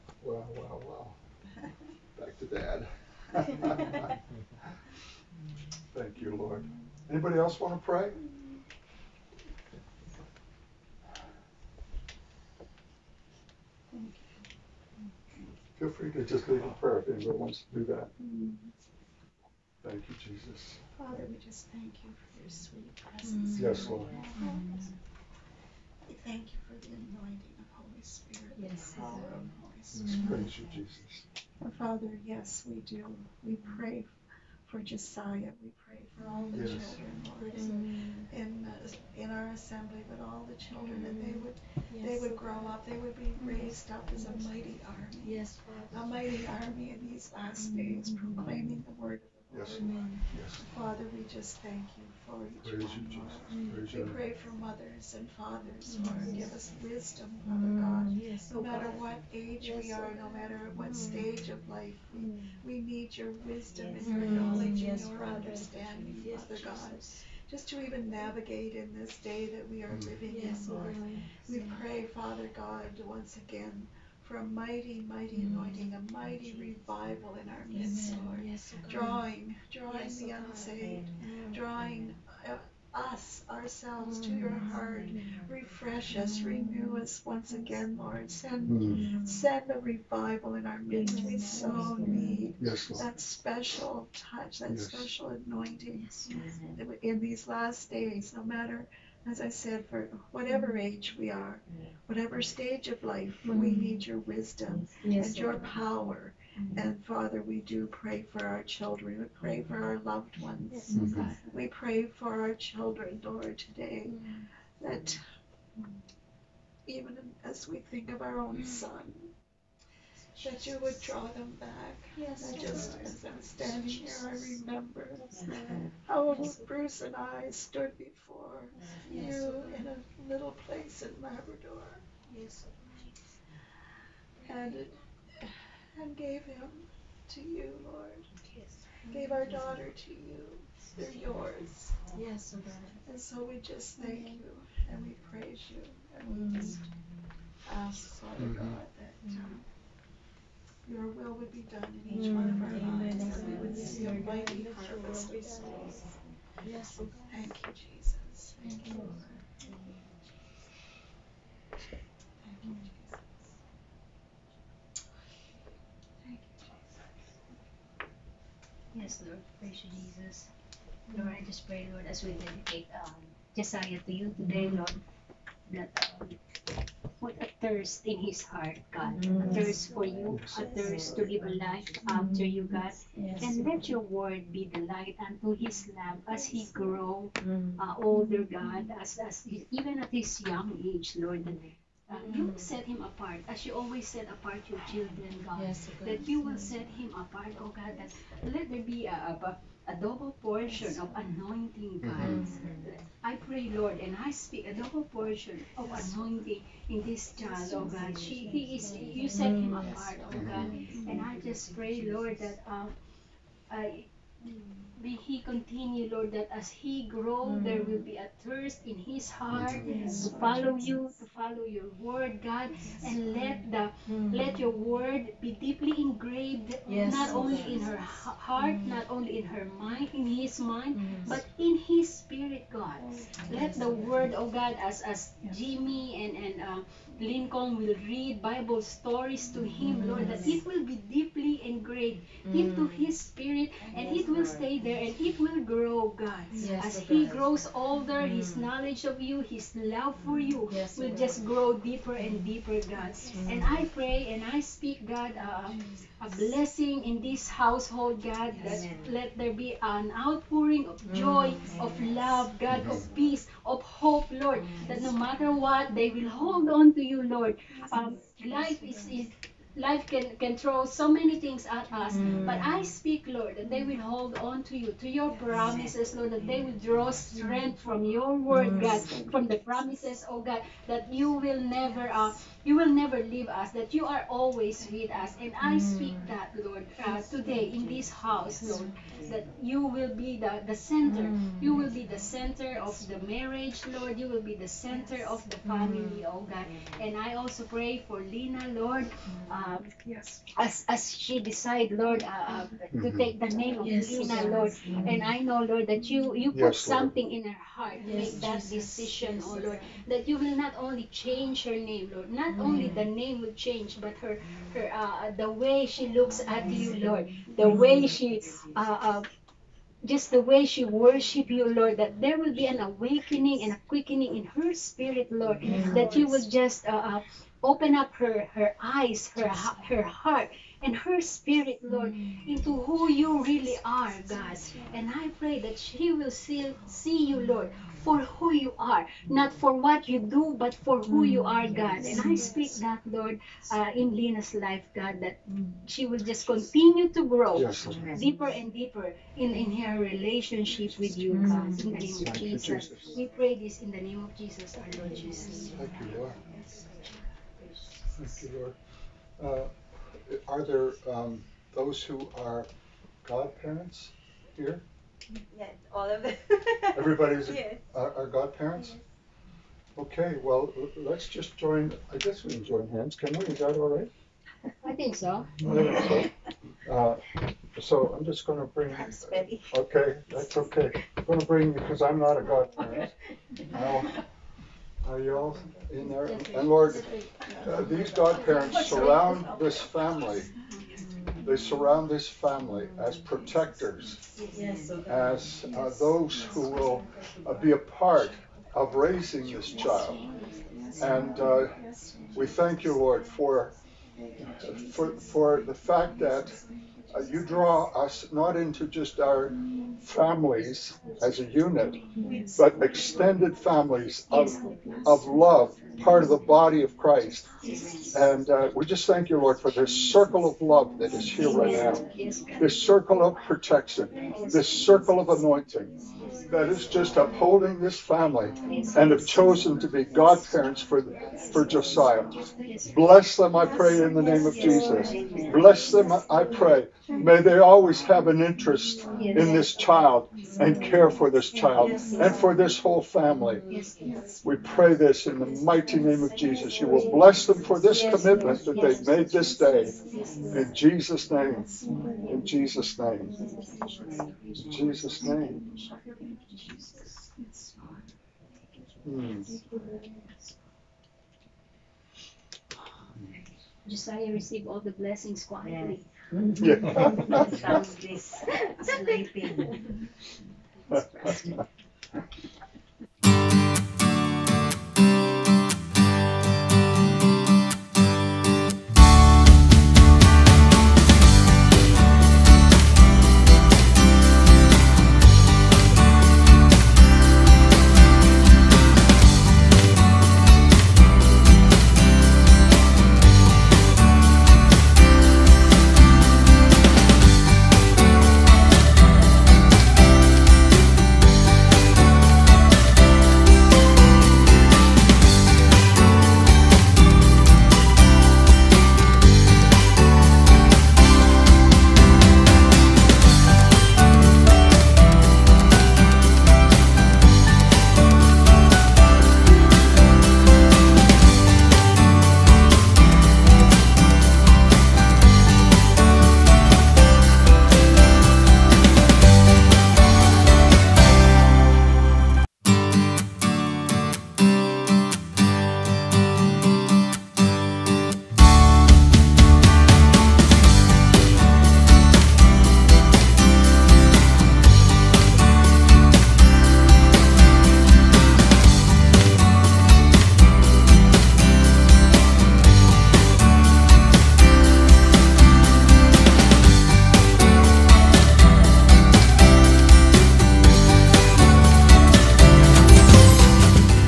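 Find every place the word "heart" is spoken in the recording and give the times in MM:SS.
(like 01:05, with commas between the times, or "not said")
01:24, 02:58, 03:39, 03:47, 05:07, 05:30.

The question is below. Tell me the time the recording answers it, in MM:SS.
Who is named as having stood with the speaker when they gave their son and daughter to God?
02:06.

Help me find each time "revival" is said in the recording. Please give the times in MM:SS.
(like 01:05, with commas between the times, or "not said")
01:16, 01:29.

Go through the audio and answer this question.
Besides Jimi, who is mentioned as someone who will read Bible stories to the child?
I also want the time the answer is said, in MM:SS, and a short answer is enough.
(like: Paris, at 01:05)
Lincoln, at 03:57.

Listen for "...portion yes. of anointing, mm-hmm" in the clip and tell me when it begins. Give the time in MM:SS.
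03:20.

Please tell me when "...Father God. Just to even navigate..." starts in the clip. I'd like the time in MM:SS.
01:06.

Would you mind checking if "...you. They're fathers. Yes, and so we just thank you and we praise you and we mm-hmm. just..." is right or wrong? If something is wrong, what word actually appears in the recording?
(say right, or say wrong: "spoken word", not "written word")
wrong: "yours", not "fathers".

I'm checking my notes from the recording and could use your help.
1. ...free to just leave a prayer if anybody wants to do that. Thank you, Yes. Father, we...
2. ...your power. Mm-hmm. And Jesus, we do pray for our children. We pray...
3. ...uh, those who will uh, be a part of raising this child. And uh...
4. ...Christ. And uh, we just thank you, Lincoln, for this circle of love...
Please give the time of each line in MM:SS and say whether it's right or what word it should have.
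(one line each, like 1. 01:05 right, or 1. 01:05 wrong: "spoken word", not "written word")
1. 00:15 wrong: "Jesus", not "Yes"
2. 01:45 wrong: "Father", not "Jesus"
3. 06:35 right
4. 06:56 wrong: "Lord", not "Lincoln".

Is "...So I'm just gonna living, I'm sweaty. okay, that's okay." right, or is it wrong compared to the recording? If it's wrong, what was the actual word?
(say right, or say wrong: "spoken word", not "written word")
wrong: "bring", not "living".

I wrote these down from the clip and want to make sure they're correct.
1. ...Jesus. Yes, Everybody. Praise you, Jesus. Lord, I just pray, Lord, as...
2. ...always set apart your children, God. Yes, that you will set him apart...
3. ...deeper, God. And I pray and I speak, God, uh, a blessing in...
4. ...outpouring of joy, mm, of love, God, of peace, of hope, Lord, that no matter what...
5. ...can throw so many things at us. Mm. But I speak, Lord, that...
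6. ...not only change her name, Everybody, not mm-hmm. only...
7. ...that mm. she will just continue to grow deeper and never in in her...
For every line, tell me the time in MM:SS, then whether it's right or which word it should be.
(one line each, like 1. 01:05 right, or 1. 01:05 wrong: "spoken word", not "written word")
1. 02:42 wrong: "Lord", not "Everybody"
2. 03:13 right
3. 04:12 right
4. 04:20 right
5. 04:30 right
6. 05:10 wrong: "Lord", not "Everybody"
7. 05:45 wrong: "deeper", not "never".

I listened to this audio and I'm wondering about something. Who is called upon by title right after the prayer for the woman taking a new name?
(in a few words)
Mr. York.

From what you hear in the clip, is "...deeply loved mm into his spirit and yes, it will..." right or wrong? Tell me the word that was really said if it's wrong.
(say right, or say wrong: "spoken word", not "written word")
wrong: "engraved", not "loved".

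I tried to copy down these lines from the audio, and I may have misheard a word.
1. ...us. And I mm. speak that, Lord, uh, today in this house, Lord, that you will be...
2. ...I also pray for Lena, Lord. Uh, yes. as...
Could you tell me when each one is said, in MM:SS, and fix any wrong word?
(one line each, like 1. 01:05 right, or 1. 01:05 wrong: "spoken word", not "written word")
1. 04:45 right
2. 04:57 right.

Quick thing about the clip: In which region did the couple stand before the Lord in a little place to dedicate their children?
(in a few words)
Labrador.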